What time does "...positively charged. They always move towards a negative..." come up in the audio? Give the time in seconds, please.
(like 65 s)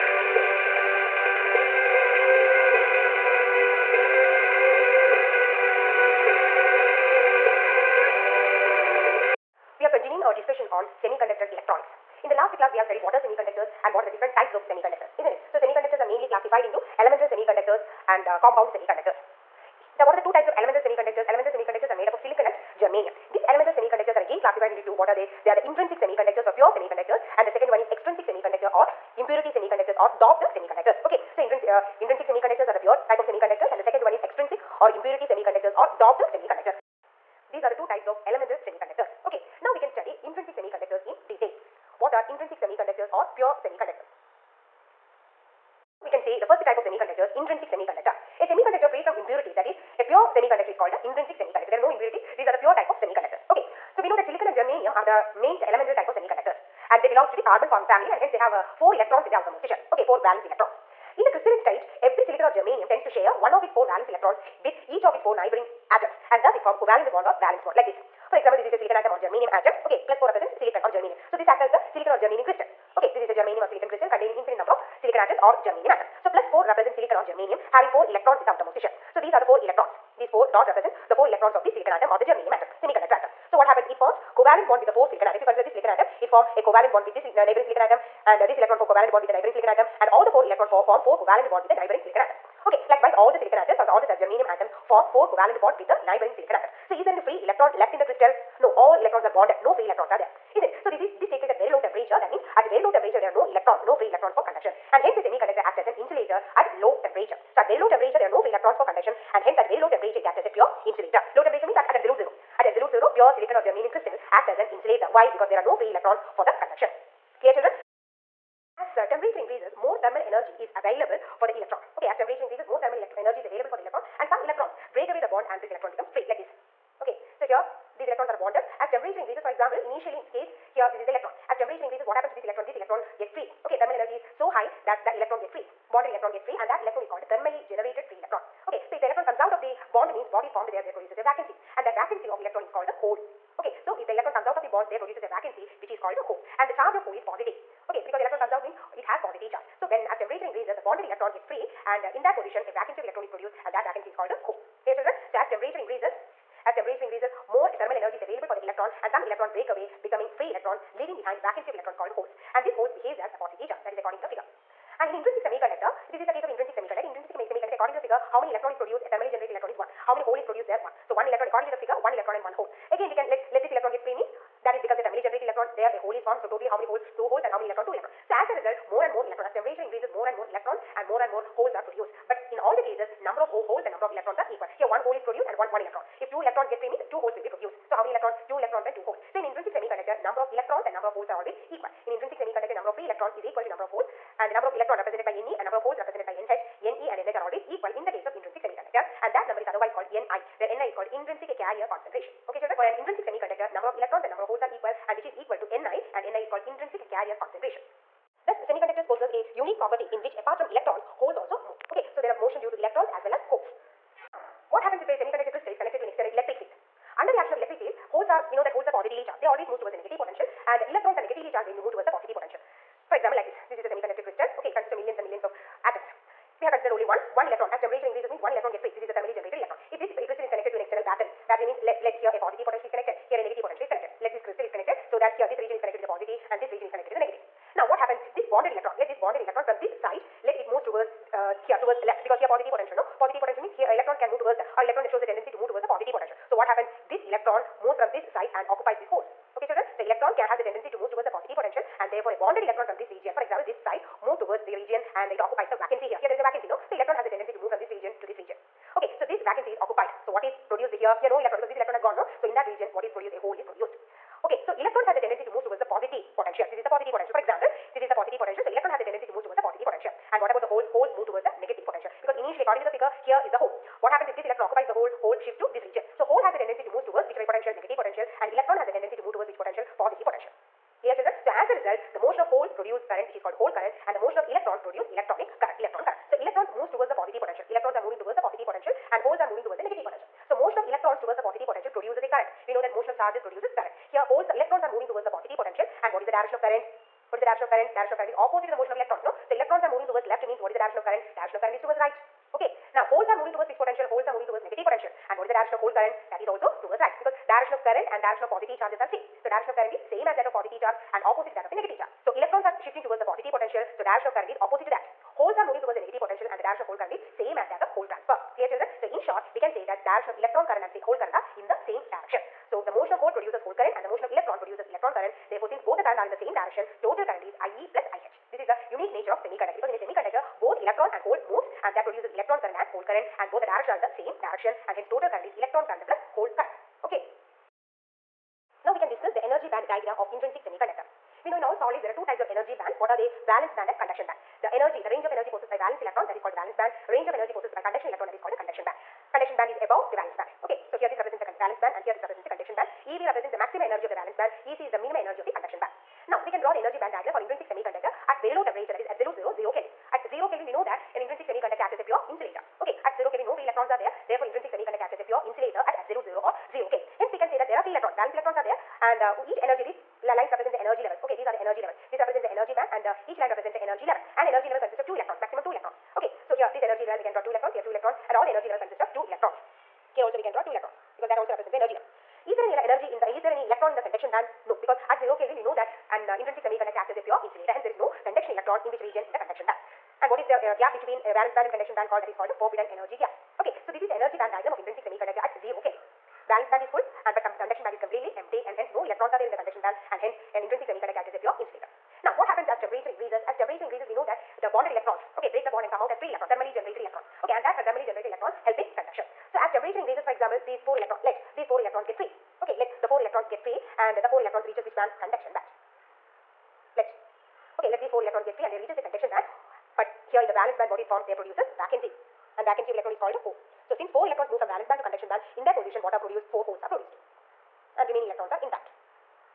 218 s.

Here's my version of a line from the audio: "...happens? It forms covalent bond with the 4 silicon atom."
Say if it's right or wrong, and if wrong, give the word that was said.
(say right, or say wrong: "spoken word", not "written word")
right.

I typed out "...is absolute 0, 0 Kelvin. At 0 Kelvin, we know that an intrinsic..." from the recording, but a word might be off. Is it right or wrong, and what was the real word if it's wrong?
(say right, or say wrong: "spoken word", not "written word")
right.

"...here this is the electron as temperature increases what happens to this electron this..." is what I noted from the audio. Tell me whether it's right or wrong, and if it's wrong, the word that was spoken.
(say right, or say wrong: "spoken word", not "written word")
right.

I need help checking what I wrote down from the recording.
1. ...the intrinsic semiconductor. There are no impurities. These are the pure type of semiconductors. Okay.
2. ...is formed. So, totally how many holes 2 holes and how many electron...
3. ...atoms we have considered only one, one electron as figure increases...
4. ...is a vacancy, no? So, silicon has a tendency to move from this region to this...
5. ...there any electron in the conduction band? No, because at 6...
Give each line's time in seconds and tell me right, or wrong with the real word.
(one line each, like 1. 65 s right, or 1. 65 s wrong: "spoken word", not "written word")
1. 50 s right
2. 176 s right
3. 225 s wrong: "temperature", not "figure"
4. 256 s wrong: "electron", not "silicon"
5. 383 s wrong: "0", not "6".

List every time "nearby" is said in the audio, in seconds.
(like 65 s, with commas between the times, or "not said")
not said.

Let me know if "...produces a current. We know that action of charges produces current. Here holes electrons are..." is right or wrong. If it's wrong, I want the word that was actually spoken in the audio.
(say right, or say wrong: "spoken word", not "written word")
wrong: "motion", not "action".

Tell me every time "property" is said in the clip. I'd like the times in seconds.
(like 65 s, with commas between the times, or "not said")
209 s.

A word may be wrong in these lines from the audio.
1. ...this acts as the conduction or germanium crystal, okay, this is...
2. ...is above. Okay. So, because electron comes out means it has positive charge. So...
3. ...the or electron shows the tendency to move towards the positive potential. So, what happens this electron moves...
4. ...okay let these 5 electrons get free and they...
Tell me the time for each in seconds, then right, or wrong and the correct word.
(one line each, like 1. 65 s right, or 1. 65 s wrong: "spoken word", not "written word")
1. 71 s wrong: "silicon", not "conduction"
2. 147 s wrong: "positive", not "above"
3. 244 s right
4. 417 s wrong: "4", not "5".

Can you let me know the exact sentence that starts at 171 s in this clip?
So, 1 electron according to the figure 1 electron and 1 hole.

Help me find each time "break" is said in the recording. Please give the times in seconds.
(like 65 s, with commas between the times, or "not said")
124 s, 159 s, 405 s.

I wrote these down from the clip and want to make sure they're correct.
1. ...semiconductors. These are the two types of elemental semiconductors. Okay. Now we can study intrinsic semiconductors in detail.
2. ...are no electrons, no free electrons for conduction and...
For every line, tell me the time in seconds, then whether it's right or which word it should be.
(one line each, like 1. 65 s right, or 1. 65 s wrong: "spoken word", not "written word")
1. 36 s right
2. 103 s right.